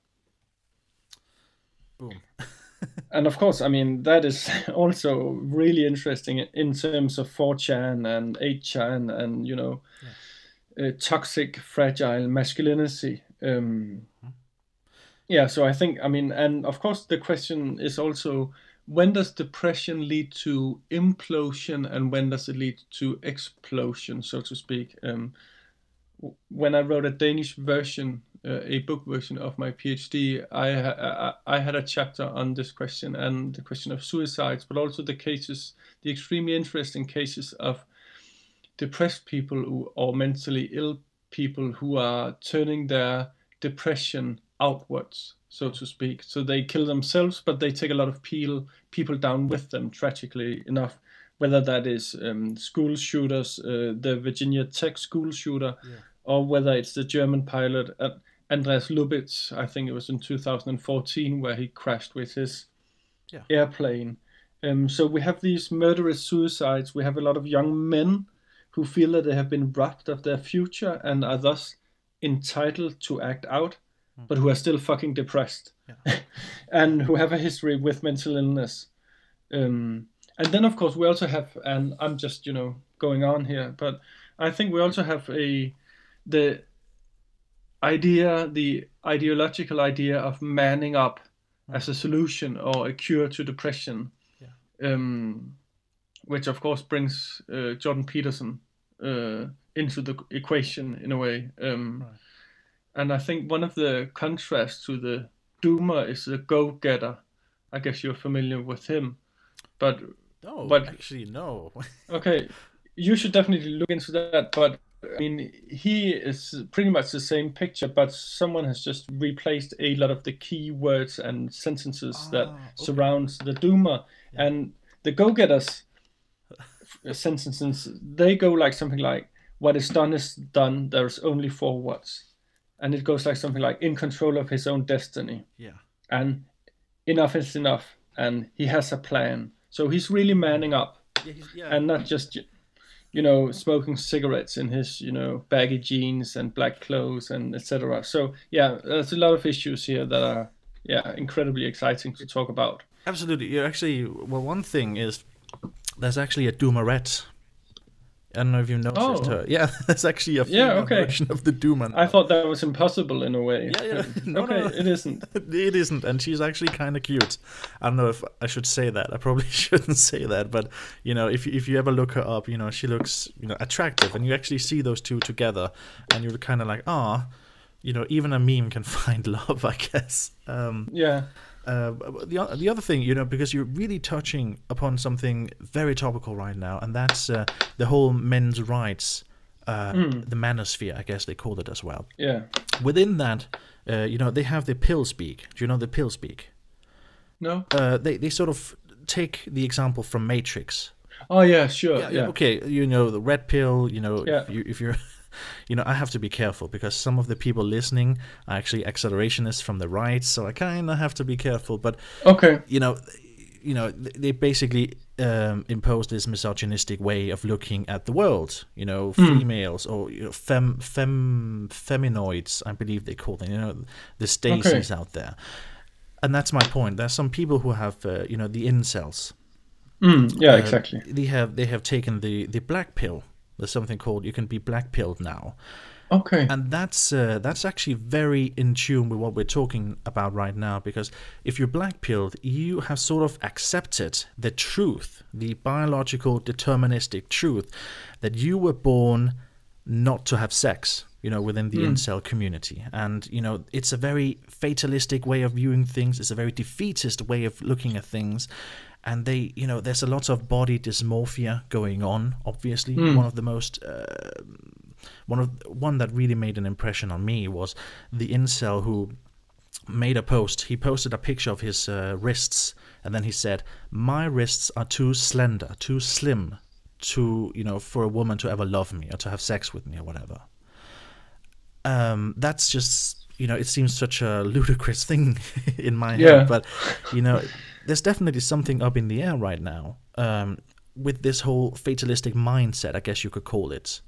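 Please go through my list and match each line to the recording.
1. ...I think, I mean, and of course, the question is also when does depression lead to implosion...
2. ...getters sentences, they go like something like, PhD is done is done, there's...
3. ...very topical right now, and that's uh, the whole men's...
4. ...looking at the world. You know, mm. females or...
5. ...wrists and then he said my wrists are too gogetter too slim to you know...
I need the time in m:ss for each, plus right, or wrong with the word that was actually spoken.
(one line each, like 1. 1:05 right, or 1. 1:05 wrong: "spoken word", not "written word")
1. 0:15 right
2. 2:05 wrong: "What", not "PhD"
3. 3:05 right
4. 3:37 right
5. 4:32 wrong: "slender", not "gogetter".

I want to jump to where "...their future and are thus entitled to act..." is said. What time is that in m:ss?
1:10.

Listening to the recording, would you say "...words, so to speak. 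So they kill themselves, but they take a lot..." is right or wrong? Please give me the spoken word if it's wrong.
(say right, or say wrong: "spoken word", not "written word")
wrong: "outwards", not "words".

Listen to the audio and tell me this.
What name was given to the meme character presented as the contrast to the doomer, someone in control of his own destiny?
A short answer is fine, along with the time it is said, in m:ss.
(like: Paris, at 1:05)
go-getter, at 1:46.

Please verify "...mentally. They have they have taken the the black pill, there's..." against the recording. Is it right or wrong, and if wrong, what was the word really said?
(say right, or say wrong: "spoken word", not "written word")
wrong: "exactly", not "mentally".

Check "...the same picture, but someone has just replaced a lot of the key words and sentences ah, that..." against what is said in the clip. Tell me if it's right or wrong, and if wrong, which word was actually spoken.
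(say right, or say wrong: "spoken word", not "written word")
right.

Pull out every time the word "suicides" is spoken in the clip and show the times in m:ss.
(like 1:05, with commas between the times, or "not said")
0:34, 1:06.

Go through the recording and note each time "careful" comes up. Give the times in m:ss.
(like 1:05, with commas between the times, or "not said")
3:26, 3:31.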